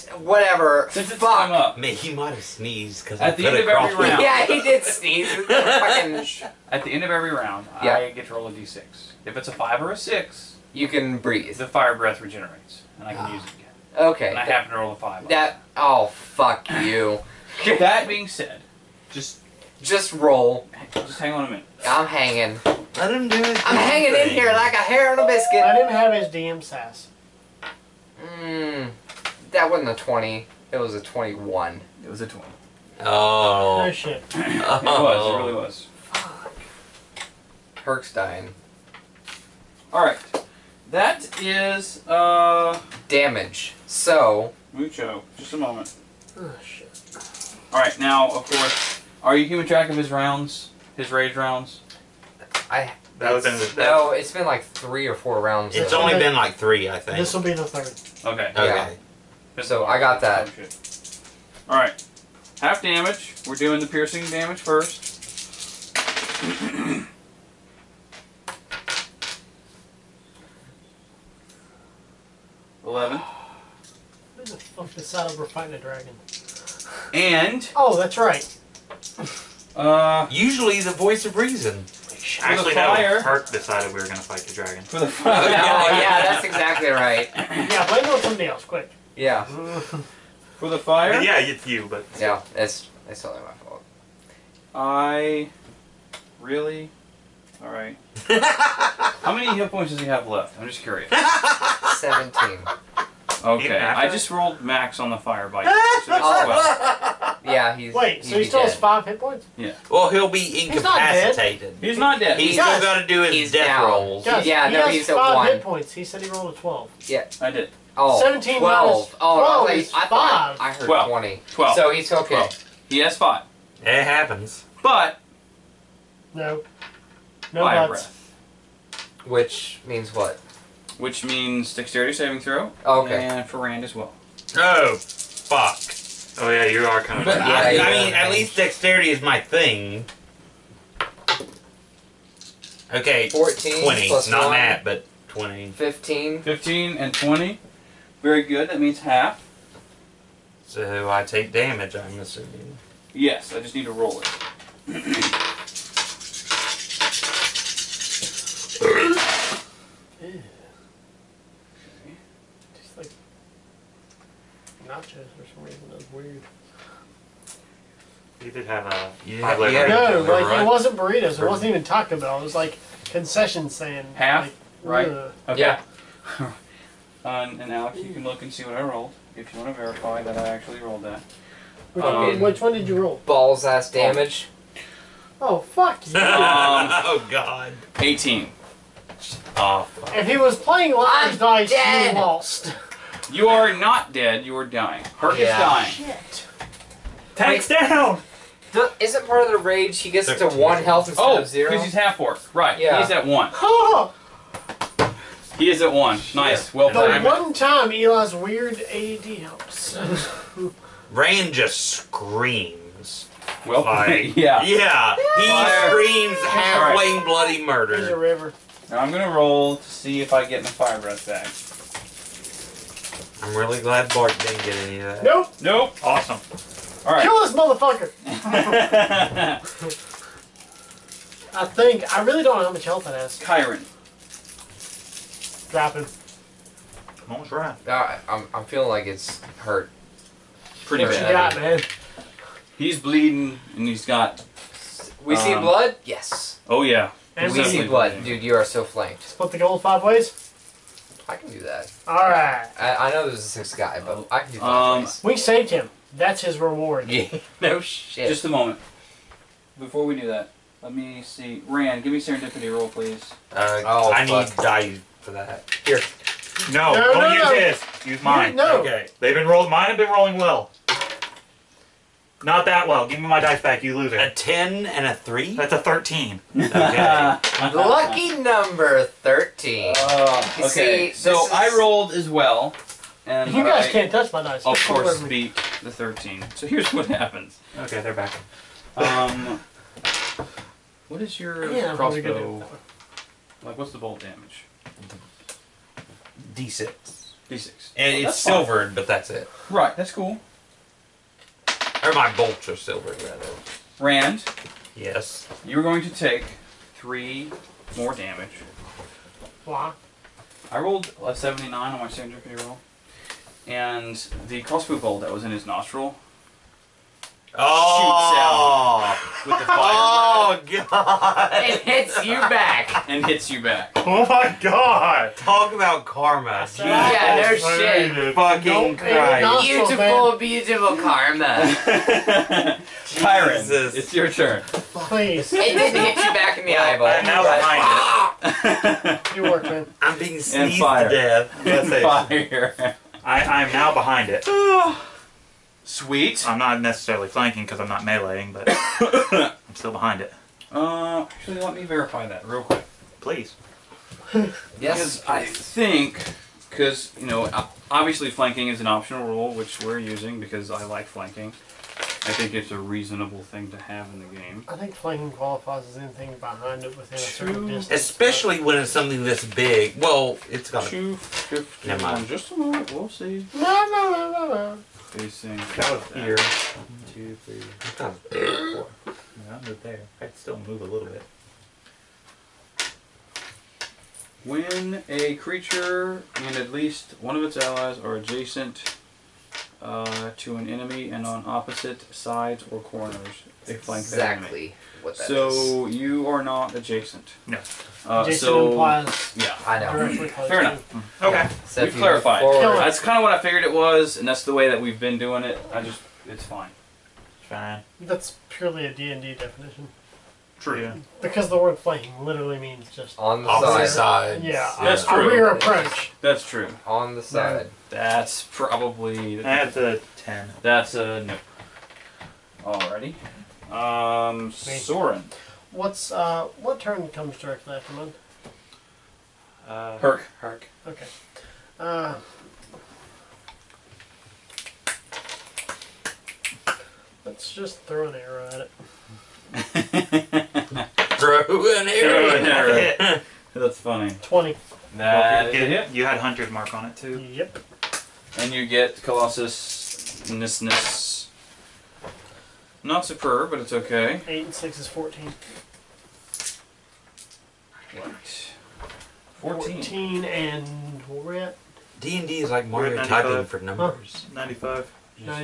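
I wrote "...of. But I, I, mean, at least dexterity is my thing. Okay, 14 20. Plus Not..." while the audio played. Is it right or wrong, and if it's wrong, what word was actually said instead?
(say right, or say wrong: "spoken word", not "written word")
right.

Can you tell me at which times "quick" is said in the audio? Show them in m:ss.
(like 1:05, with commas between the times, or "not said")
1:28, 5:52.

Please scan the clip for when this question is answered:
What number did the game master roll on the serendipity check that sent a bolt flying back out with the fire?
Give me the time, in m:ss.
5:11.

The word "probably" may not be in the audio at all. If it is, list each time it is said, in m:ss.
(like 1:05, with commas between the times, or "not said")
6:58.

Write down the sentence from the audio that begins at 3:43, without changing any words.
I'm really glad Bart didn't get any of that.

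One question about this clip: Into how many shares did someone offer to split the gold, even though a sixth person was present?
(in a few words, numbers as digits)
5.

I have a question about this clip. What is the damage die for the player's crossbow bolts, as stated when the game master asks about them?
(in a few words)
D6.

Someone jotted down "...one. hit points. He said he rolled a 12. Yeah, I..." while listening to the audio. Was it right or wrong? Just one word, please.
right.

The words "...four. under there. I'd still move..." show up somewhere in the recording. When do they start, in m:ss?
6:19.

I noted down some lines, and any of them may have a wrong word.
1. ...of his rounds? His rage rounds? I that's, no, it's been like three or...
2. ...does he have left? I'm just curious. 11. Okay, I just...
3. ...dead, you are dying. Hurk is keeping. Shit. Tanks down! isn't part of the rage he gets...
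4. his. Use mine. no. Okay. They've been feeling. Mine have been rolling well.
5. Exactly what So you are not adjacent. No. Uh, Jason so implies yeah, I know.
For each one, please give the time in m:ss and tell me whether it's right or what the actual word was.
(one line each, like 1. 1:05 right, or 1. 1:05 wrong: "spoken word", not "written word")
1. 0:49 right
2. 1:39 wrong: "17", not "11"
3. 3:14 wrong: "dying", not "keeping"
4. 4:27 wrong: "rolling", not "feeling"
5. 6:34 right.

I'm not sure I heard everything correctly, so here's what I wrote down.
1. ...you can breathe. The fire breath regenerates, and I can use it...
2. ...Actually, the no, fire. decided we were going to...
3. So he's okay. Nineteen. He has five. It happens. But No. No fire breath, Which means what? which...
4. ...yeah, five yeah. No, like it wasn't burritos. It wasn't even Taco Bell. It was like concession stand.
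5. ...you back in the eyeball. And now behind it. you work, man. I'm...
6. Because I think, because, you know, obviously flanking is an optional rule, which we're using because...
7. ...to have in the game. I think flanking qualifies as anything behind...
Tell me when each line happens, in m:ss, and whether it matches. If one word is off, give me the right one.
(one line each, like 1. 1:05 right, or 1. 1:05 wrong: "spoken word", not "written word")
1. 0:10 right
2. 1:22 right
3. 2:01 wrong: "Twelve", not "Nineteen"
4. 2:49 right
5. 5:36 right
6. 5:54 right
7. 6:03 right.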